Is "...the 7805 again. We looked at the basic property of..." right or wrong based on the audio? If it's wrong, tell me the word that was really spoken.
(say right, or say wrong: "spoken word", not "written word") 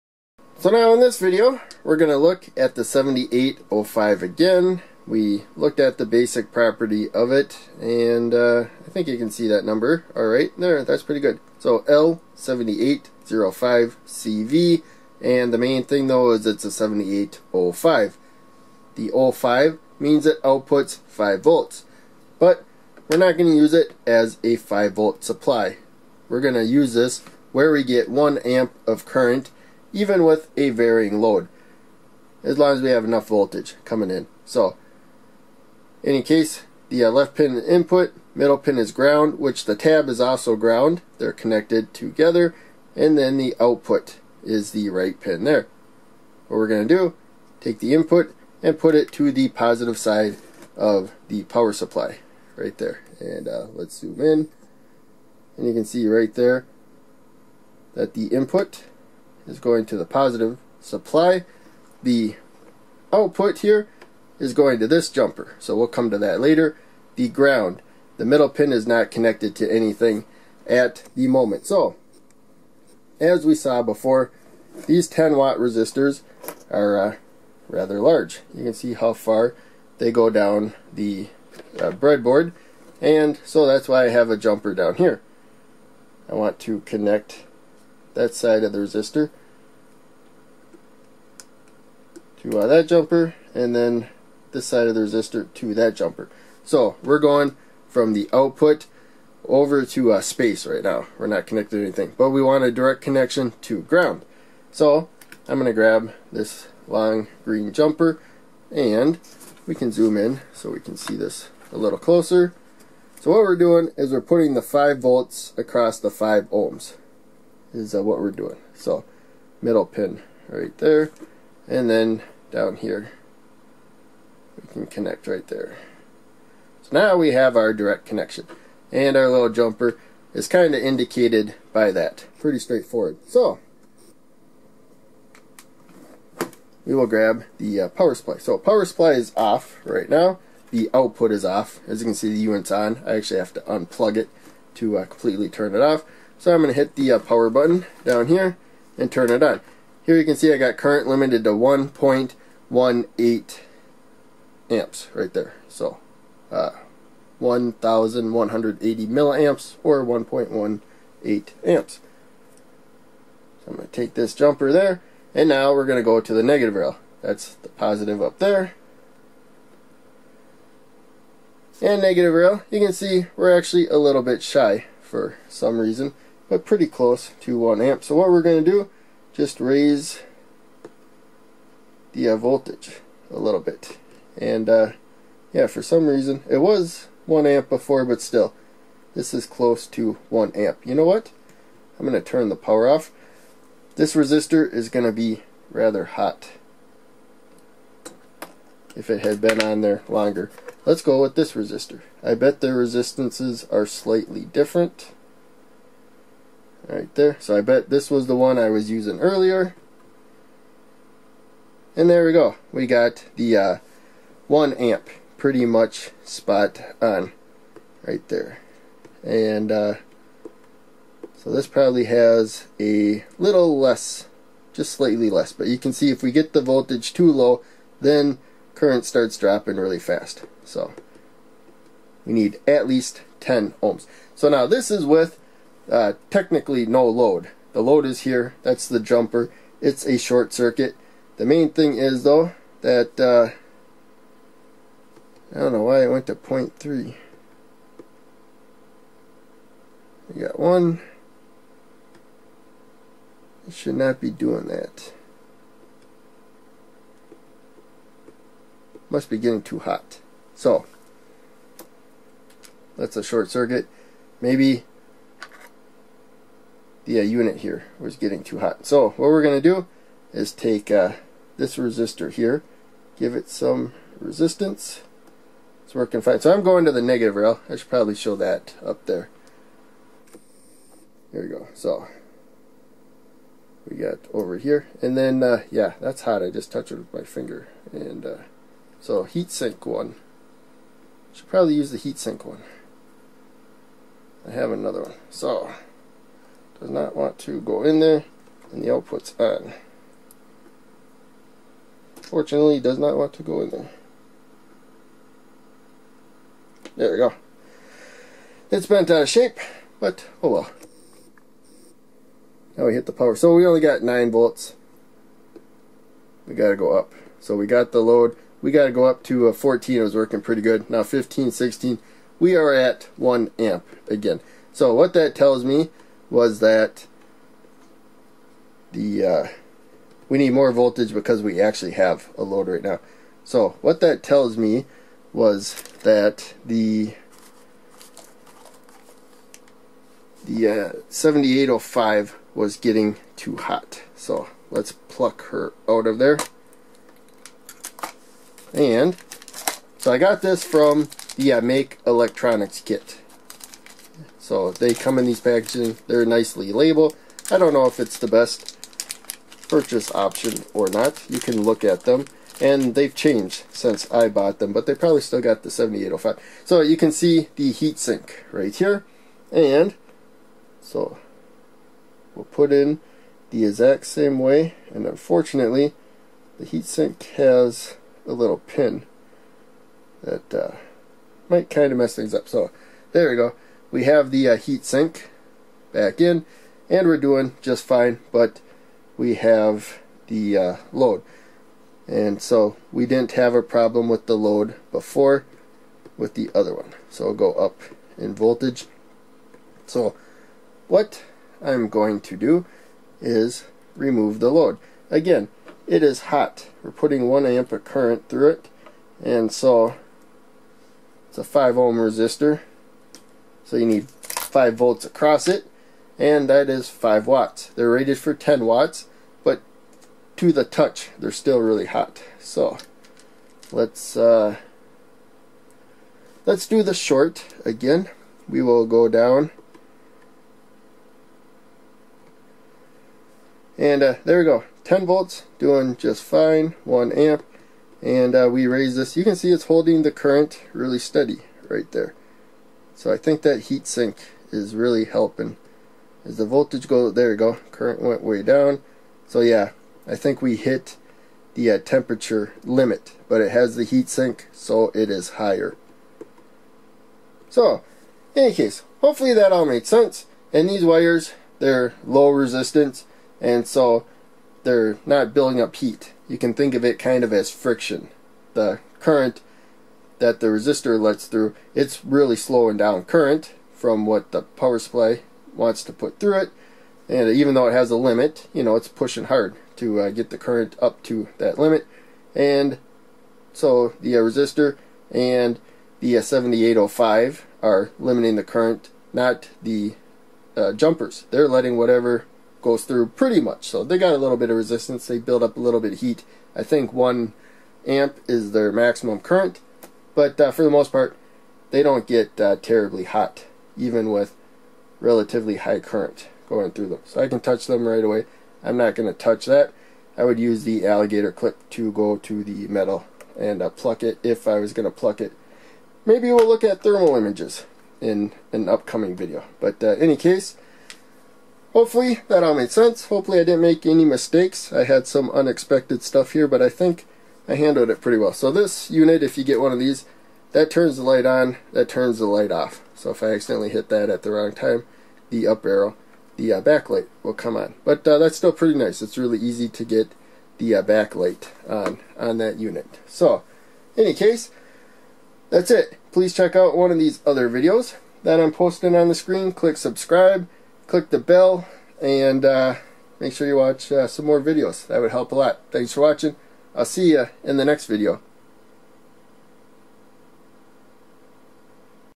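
right.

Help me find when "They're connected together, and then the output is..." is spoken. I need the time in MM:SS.
00:41.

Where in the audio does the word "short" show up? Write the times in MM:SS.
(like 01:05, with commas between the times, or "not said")
04:00, 04:23, 07:06.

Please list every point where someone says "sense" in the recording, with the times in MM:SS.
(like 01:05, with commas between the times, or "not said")
07:39, 08:42.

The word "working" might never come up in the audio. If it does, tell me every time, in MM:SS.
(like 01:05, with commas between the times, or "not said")
04:35, 05:20.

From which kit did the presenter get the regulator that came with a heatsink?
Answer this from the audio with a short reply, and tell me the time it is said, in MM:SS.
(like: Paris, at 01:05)
Make Electronics Kit, at 05:51.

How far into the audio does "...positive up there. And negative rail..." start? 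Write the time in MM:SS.
02:47.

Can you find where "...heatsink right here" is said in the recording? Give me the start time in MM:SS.
06:07.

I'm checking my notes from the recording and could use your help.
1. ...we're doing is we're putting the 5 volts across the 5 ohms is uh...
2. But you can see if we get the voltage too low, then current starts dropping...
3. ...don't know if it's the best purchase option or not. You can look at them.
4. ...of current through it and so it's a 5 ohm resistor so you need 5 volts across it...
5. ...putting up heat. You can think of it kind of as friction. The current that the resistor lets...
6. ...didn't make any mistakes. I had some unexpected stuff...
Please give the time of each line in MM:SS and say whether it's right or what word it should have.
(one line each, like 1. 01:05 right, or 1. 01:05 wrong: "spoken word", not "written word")
1. 01:53 right
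2. 03:45 right
3. 05:57 right
4. 06:47 right
5. 07:45 wrong: "building", not "putting"
6. 08:43 right.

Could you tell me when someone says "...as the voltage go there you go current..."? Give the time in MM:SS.
07:26.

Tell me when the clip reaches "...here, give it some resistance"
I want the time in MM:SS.
04:32.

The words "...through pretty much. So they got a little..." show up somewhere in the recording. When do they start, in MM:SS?
08:12.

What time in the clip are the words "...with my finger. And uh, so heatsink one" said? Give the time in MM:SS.
04:46.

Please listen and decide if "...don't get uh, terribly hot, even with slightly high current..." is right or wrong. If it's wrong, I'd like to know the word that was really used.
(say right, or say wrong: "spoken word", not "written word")
wrong: "relatively", not "slightly".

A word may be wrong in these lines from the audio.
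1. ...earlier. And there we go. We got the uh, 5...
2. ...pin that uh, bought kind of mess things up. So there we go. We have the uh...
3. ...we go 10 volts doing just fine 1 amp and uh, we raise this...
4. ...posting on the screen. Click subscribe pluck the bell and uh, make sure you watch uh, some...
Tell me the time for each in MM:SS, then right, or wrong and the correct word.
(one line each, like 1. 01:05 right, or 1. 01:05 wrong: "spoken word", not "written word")
1. 03:29 wrong: "1", not "5"
2. 06:18 wrong: "might", not "bought"
3. 07:14 right
4. 09:08 wrong: "click", not "pluck".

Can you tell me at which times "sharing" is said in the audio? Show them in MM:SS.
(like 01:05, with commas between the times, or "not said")
not said.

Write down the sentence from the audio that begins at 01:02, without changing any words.
The output here is going to this jumper, so we'll come to that later.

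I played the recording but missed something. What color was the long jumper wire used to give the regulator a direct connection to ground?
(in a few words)
green.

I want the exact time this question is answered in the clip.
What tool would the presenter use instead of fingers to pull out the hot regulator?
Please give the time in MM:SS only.
08:30.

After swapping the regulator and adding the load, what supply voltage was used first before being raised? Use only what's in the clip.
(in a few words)
9 volts.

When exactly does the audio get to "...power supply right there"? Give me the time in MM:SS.
00:51.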